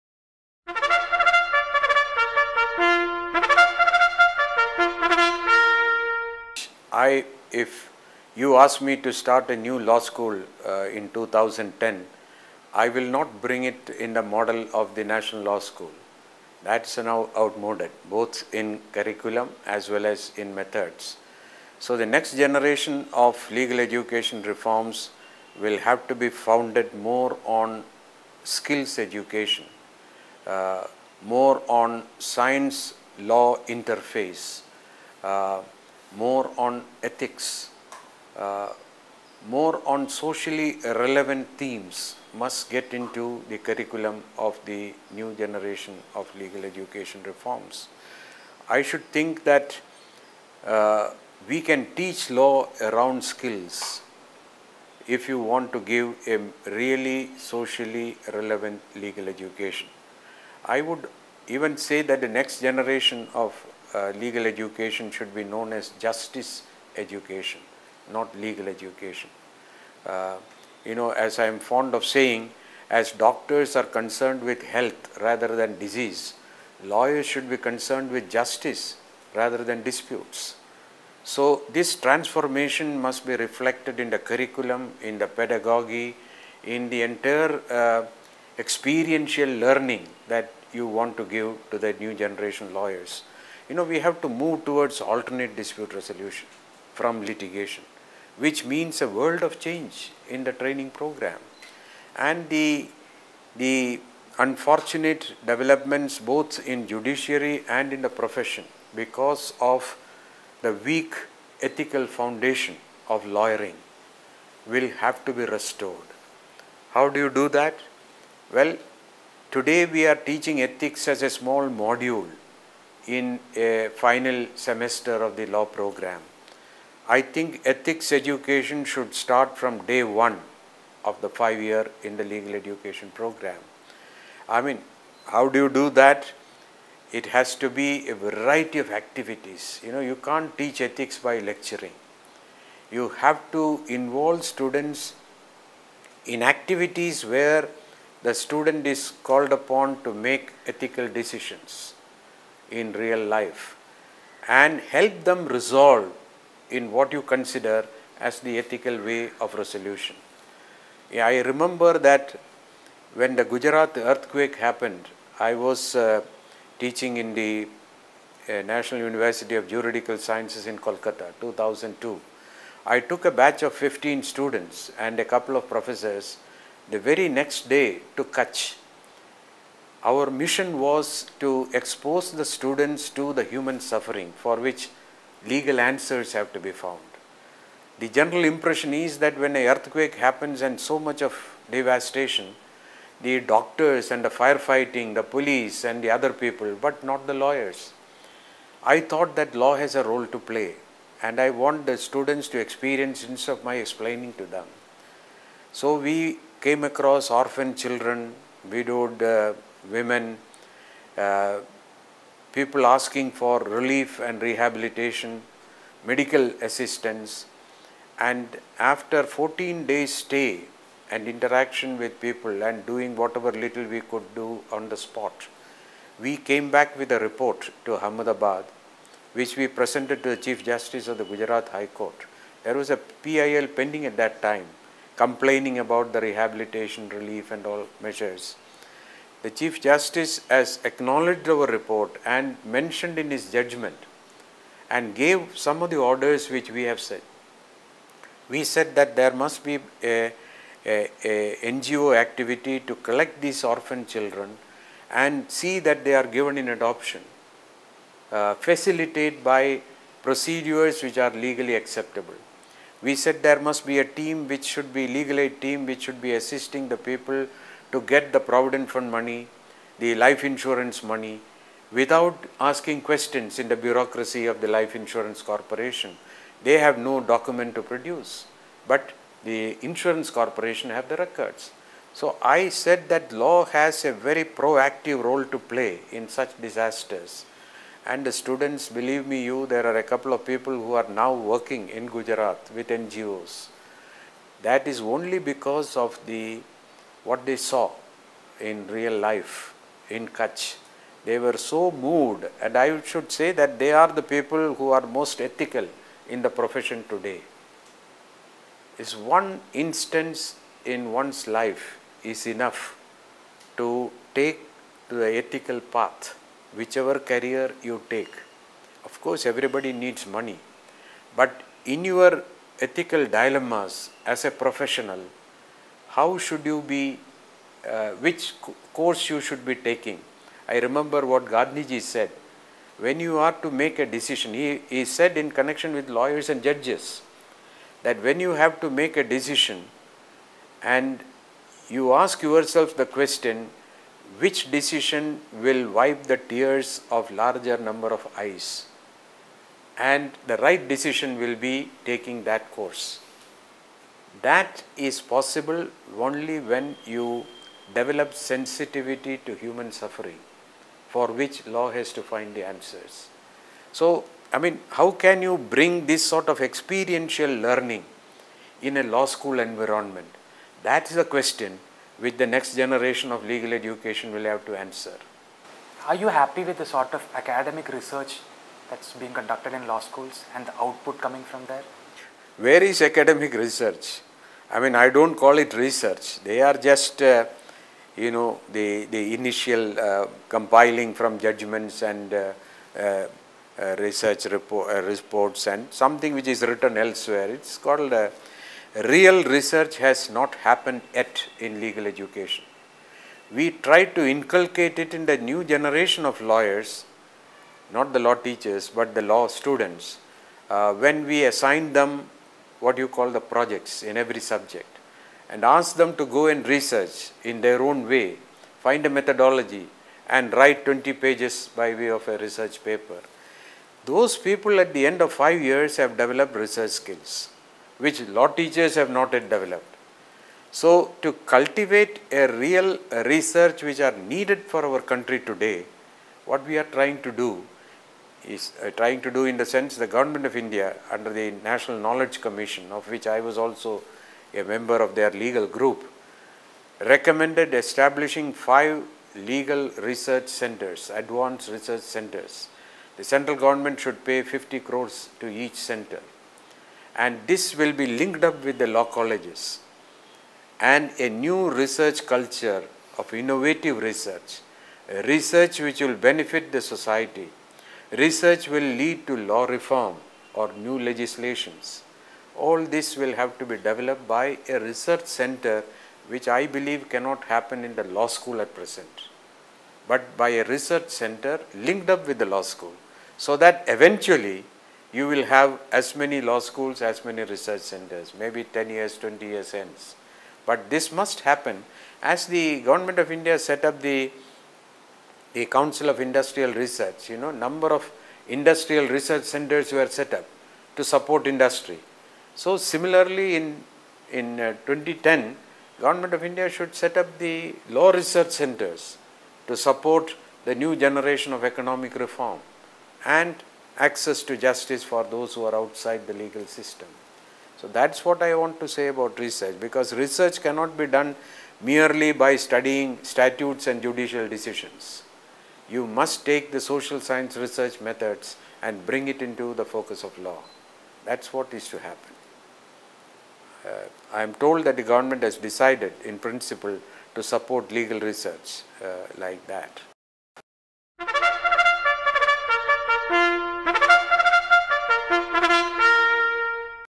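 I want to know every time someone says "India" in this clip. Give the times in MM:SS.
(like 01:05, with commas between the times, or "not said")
07:20, 08:13, 08:26.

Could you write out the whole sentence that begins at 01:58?
Well, today we are teaching ethics as a small module in a final semester of the law program.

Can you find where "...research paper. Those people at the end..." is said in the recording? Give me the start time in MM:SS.
07:02.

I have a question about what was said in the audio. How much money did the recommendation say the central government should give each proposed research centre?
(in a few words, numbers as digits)
50 crores.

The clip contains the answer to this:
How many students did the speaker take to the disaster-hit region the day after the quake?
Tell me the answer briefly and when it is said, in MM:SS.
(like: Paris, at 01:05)
15, at 02:53.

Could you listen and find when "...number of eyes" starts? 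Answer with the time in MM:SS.
05:47.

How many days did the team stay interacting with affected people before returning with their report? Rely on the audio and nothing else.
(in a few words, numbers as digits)
14.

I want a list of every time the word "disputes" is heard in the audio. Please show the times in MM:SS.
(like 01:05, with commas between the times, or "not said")
01:19, 01:35.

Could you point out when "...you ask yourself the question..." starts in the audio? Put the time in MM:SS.
05:41.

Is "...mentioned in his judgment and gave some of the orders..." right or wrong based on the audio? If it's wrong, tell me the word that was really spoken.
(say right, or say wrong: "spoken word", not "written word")
right.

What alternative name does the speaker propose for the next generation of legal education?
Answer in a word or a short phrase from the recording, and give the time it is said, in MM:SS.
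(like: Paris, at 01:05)
justice education, at 01:06.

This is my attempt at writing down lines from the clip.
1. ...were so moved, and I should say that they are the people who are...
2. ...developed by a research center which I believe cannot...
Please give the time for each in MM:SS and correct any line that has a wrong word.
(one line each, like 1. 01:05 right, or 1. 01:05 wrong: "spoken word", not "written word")
1. 05:01 right
2. 07:53 right.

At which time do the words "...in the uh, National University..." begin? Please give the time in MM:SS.
02:47.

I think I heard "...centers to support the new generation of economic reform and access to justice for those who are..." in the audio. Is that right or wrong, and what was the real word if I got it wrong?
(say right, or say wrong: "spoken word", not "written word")
right.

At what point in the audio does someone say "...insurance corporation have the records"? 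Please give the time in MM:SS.
04:39.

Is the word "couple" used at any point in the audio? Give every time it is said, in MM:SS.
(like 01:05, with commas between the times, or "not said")
02:55, 04:50.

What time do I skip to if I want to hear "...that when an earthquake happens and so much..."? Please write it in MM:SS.
03:09.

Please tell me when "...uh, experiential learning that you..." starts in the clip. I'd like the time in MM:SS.
01:27.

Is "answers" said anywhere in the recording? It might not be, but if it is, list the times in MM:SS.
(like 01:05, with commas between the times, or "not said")
03:05, 06:02, 06:14.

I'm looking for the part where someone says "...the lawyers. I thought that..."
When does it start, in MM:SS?
03:17.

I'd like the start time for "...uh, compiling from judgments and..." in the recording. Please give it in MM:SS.
06:29.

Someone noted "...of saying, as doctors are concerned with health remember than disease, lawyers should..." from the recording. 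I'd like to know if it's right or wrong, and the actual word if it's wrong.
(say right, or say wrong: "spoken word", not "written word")
wrong: "rather", not "remember".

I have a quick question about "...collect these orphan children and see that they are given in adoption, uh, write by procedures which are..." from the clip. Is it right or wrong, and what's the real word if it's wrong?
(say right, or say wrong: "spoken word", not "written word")
wrong: "facilitate", not "write".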